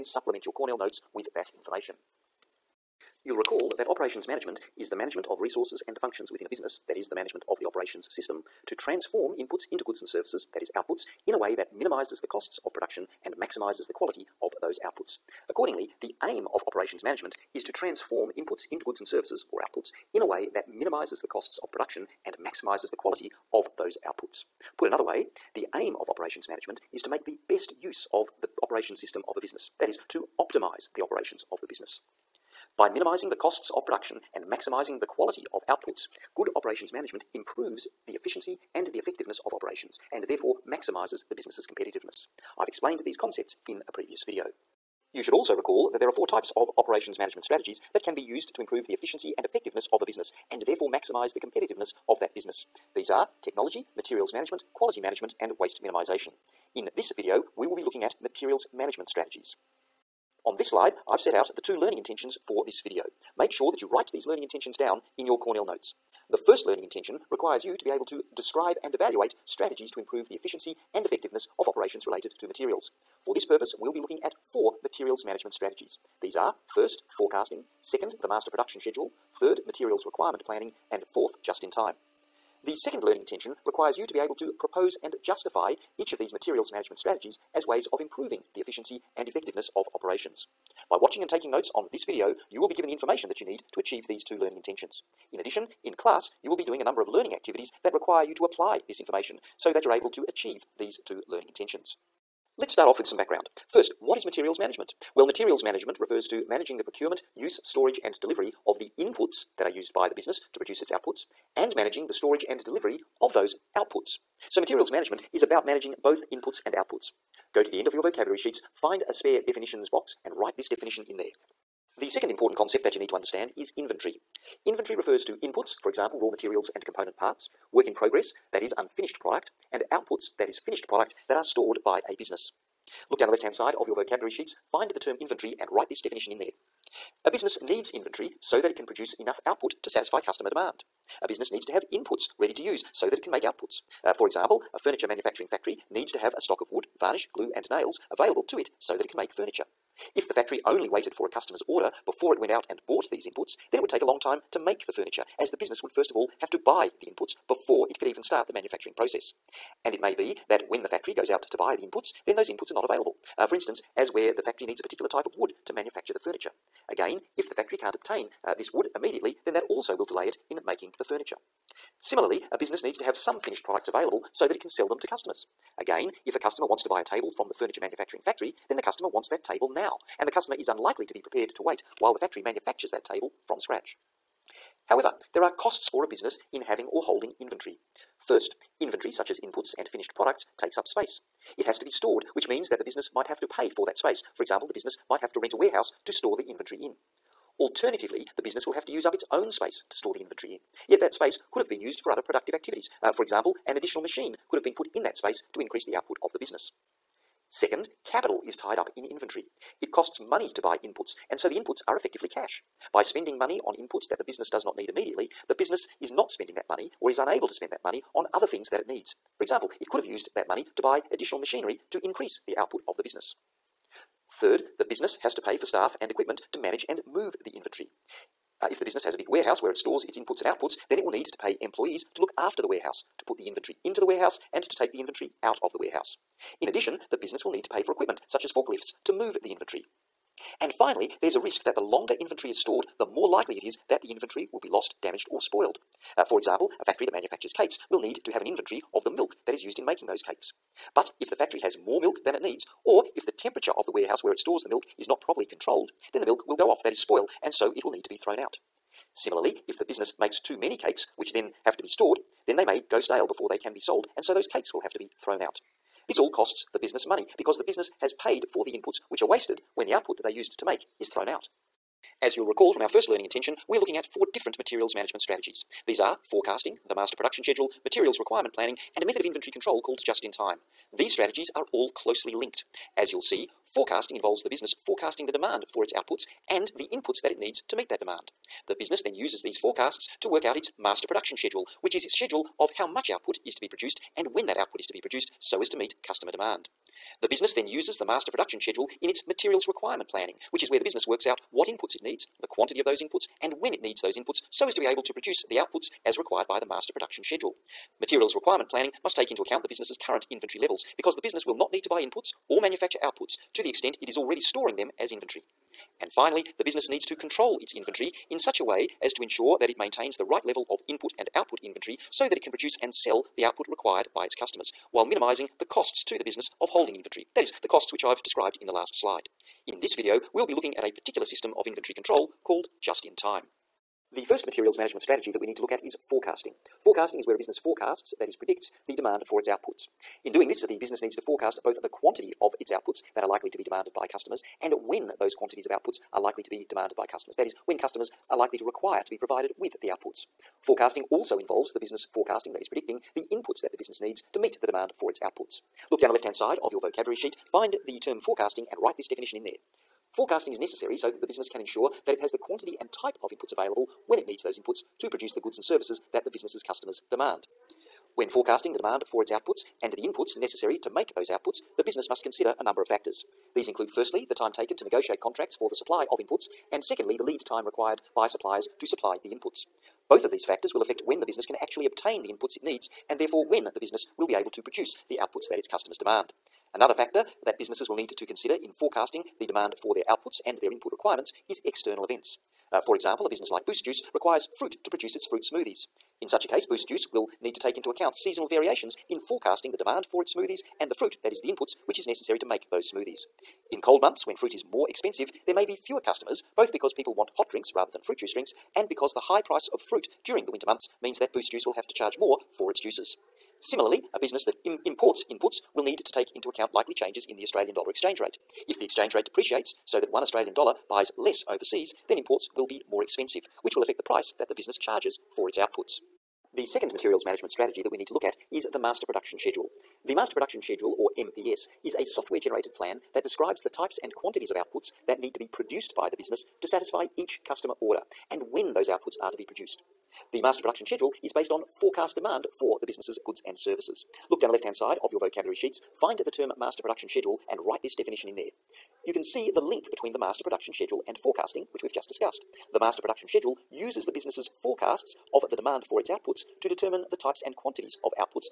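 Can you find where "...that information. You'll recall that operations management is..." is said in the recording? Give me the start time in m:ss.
0:01.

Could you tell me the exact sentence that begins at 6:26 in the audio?
Another factor that businesses will need to consider in forecasting the demand for their outputs and their input requirements is external events.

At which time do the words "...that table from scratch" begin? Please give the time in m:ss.
3:02.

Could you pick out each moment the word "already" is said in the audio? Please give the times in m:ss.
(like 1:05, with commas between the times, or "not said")
5:14.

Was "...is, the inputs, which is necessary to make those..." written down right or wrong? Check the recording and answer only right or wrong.
right.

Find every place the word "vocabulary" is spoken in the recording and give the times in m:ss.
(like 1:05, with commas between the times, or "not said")
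1:58, 2:13, 5:56, 7:25.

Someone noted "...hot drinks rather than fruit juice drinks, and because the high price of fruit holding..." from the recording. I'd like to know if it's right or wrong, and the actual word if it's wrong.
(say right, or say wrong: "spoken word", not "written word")
wrong: "during", not "holding".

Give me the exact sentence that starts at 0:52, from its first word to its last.
These are technology, materials management, quality management and waste minimisation.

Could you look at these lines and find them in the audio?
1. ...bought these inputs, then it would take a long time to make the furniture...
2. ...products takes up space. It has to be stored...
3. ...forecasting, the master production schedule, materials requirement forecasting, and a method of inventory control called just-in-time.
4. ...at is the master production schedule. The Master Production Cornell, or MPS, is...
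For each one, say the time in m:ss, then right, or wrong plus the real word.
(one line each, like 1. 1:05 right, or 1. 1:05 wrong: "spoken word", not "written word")
1. 2:32 right
2. 3:10 right
3. 4:36 wrong: "planning", not "forecasting"
4. 7:08 wrong: "Schedule", not "Cornell".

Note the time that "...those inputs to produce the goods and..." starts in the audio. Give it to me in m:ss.
6:04.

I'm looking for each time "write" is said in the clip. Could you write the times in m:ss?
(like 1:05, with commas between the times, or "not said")
1:03, 2:00, 2:15, 5:58, 7:27.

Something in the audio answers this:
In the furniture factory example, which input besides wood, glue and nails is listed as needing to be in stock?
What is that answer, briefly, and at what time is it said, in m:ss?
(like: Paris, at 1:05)
Varnish, at 2:26.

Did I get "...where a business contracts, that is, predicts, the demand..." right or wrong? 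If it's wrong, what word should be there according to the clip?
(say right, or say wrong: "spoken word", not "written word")
wrong: "forecasts", not "contracts".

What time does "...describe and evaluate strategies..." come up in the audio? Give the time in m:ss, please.
1:08.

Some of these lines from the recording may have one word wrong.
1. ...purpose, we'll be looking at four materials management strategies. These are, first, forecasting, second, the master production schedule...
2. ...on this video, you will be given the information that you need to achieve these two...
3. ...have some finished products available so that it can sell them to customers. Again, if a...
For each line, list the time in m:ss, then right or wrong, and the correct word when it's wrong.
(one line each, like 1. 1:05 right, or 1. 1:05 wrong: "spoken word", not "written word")
1. 1:13 right
2. 1:31 right
3. 2:53 right.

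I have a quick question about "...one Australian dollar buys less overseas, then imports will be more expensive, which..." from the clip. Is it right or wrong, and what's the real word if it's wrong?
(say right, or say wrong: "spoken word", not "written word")
right.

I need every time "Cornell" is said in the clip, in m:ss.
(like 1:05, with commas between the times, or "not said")
0:00, 1:05.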